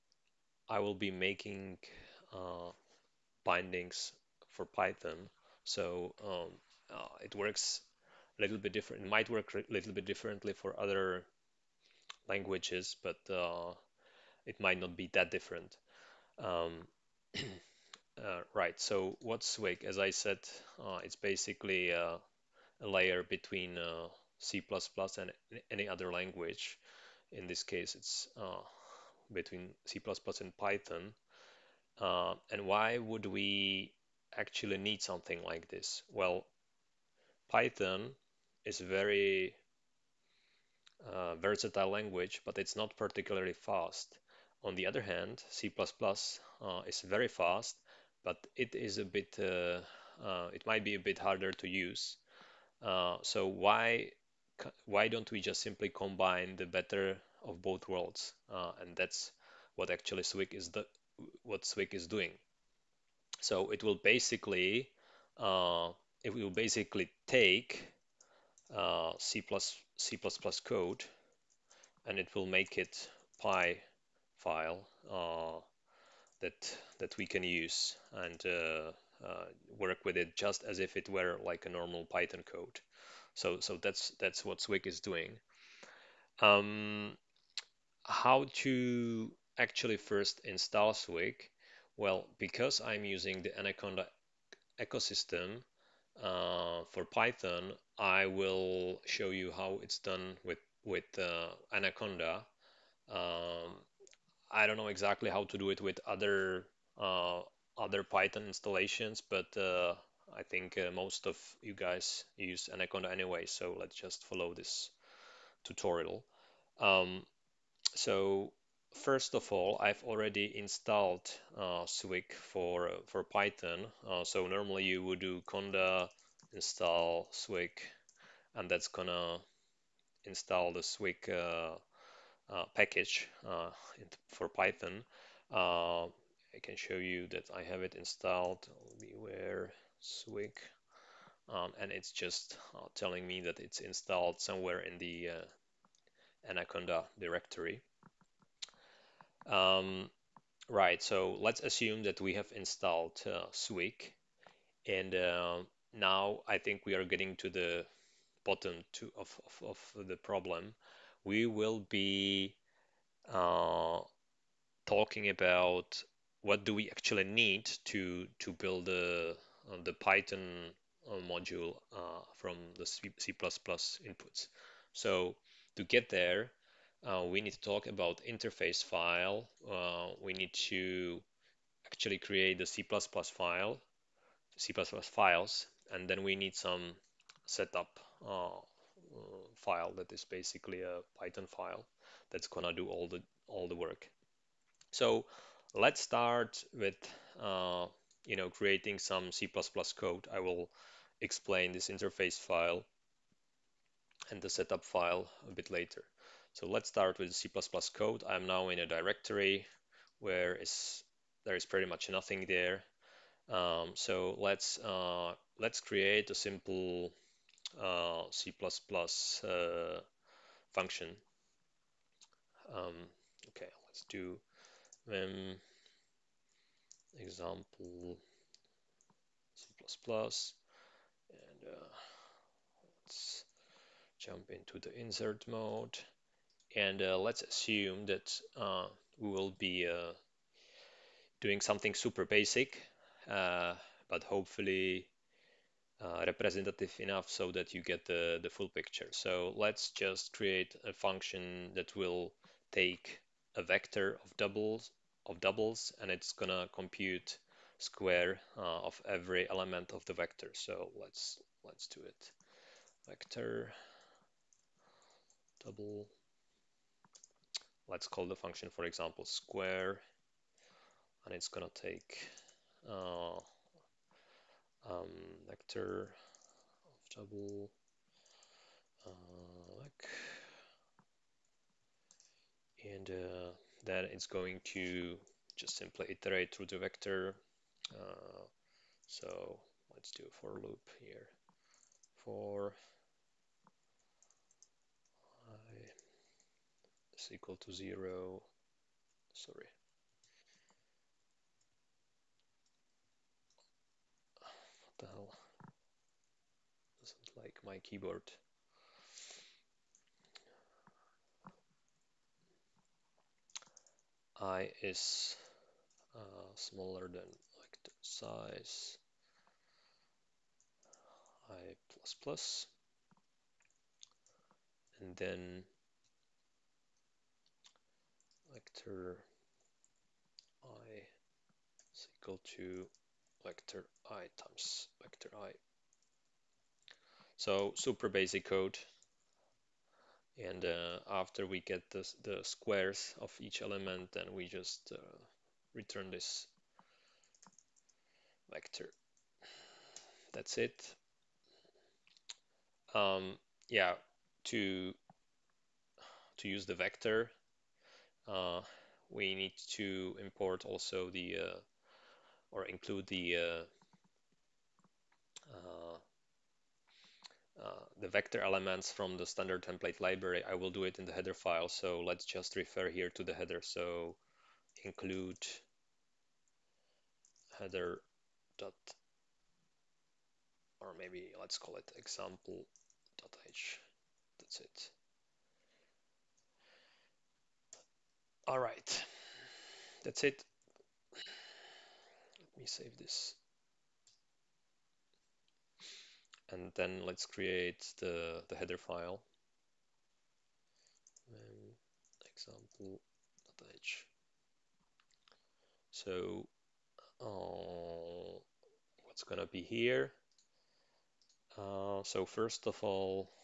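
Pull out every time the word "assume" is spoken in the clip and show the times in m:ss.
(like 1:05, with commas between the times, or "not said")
2:31, 3:57.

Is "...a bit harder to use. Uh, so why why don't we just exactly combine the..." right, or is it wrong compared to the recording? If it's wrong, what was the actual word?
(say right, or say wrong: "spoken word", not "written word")
wrong: "simply", not "exactly".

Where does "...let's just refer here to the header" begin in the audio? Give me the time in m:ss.
6:11.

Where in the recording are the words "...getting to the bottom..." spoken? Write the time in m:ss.
2:37.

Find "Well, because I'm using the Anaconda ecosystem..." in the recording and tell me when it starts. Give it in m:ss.
1:31.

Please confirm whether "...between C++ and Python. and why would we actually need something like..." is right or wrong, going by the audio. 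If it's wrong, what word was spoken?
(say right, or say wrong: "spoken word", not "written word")
right.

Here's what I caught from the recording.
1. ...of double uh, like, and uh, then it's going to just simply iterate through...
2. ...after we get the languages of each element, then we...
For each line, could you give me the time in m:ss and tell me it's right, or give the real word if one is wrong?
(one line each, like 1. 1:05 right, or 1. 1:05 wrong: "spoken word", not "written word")
1. 4:37 right
2. 5:41 wrong: "squares", not "languages".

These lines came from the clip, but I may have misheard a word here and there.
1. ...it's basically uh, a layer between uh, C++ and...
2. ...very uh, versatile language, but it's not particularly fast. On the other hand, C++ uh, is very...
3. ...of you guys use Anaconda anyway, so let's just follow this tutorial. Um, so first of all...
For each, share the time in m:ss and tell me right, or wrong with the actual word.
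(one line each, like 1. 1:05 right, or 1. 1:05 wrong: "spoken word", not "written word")
1. 0:21 right
2. 0:38 right
3. 1:51 right.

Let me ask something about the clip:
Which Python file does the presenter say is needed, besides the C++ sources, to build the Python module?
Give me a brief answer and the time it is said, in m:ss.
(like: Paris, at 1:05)
setup file, at 3:07.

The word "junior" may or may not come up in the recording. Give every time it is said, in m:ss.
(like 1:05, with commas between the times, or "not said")
not said.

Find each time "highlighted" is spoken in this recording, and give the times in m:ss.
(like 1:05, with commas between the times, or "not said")
not said.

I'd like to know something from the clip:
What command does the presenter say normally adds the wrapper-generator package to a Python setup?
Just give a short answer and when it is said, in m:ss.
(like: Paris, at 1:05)
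conda install Swig, at 2:05.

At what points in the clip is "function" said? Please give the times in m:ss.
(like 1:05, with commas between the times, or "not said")
3:40, 4:10, 4:28.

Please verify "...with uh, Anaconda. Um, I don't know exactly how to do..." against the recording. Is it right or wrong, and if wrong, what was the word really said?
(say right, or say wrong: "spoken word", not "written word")
right.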